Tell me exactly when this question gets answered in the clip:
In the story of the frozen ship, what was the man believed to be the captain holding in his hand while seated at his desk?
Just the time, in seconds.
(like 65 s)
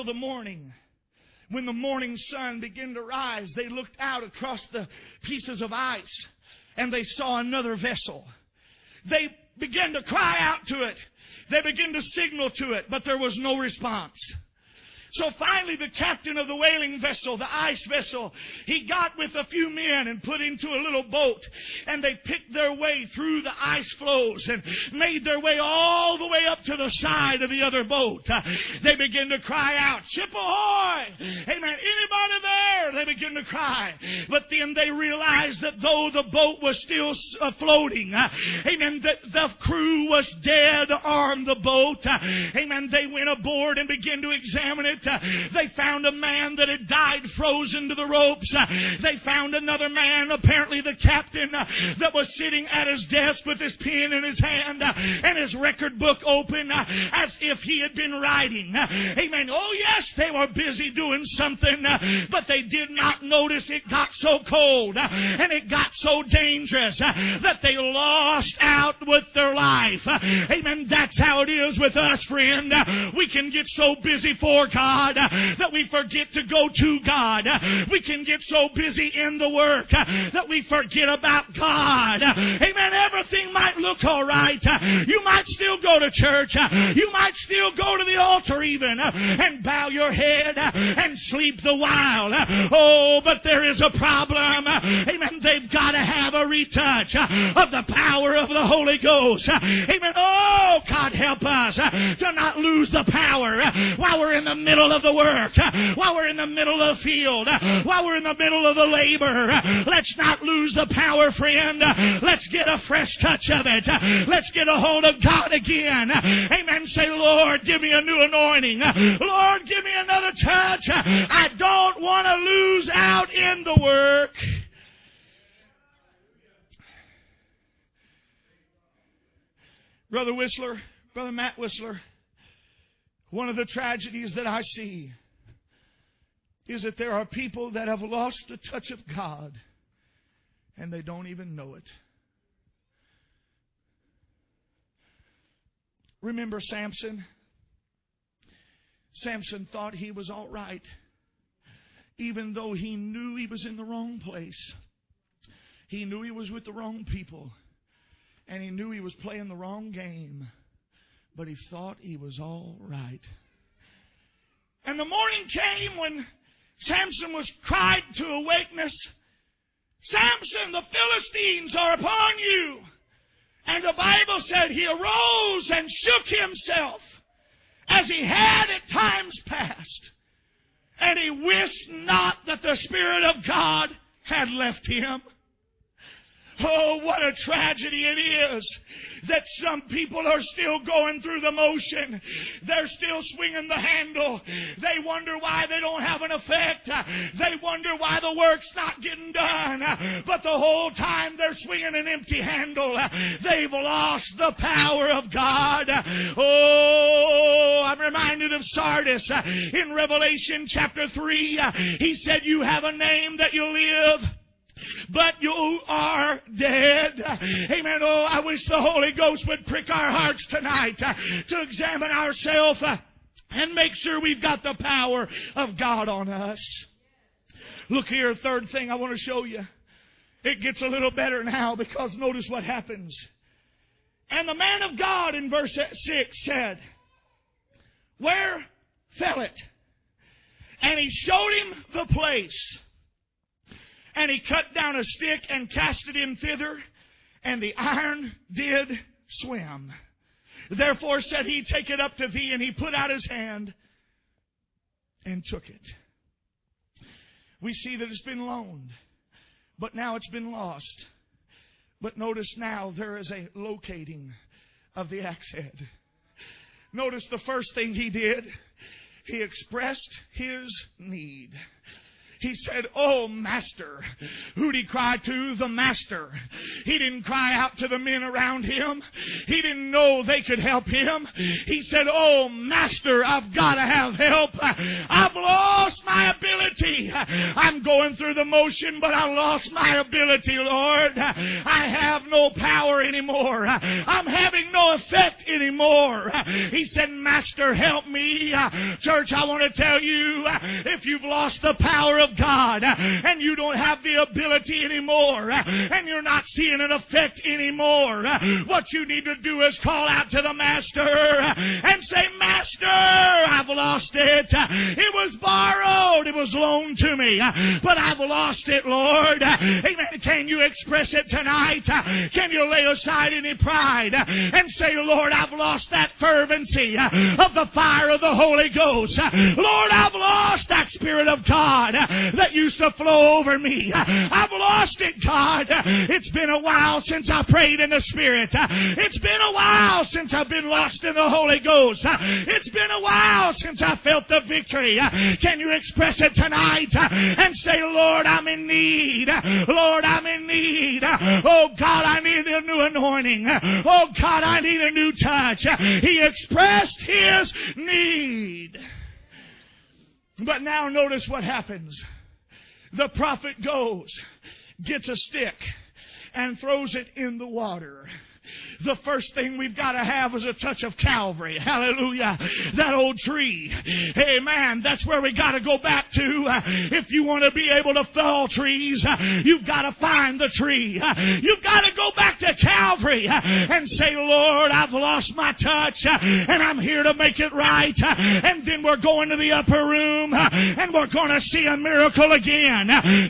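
53 s.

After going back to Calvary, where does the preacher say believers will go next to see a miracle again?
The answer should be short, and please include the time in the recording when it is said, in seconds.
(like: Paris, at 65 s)
the upper room, at 389 s.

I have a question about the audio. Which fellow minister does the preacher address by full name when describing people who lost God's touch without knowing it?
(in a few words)
Matt Whistler.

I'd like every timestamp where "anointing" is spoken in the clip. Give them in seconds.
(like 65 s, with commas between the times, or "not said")
118 s, 352 s.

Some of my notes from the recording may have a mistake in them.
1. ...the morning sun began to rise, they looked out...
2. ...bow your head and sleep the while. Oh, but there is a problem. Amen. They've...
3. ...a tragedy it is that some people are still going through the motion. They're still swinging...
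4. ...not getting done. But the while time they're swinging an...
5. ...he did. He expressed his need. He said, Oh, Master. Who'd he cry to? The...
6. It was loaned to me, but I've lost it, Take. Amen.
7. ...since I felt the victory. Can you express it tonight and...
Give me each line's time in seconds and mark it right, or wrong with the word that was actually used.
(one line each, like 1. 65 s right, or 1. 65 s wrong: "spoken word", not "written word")
1. 1 s right
2. 89 s right
3. 187 s right
4. 198 s wrong: "whole", not "while"
5. 267 s right
6. 316 s wrong: "Lord", not "Take"
7. 343 s right.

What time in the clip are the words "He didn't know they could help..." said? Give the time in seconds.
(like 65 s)
279 s.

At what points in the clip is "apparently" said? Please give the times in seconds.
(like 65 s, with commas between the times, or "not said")
50 s.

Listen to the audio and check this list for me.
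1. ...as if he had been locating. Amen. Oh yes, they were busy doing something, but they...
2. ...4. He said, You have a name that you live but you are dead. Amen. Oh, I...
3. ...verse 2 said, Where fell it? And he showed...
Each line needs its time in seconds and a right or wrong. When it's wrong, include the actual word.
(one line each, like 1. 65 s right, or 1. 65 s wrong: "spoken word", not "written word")
1. 56 s wrong: "writing", not "locating"
2. 211 s wrong: "3", not "4"
3. 235 s wrong: "6", not "2".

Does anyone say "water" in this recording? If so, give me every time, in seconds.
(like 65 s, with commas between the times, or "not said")
367 s.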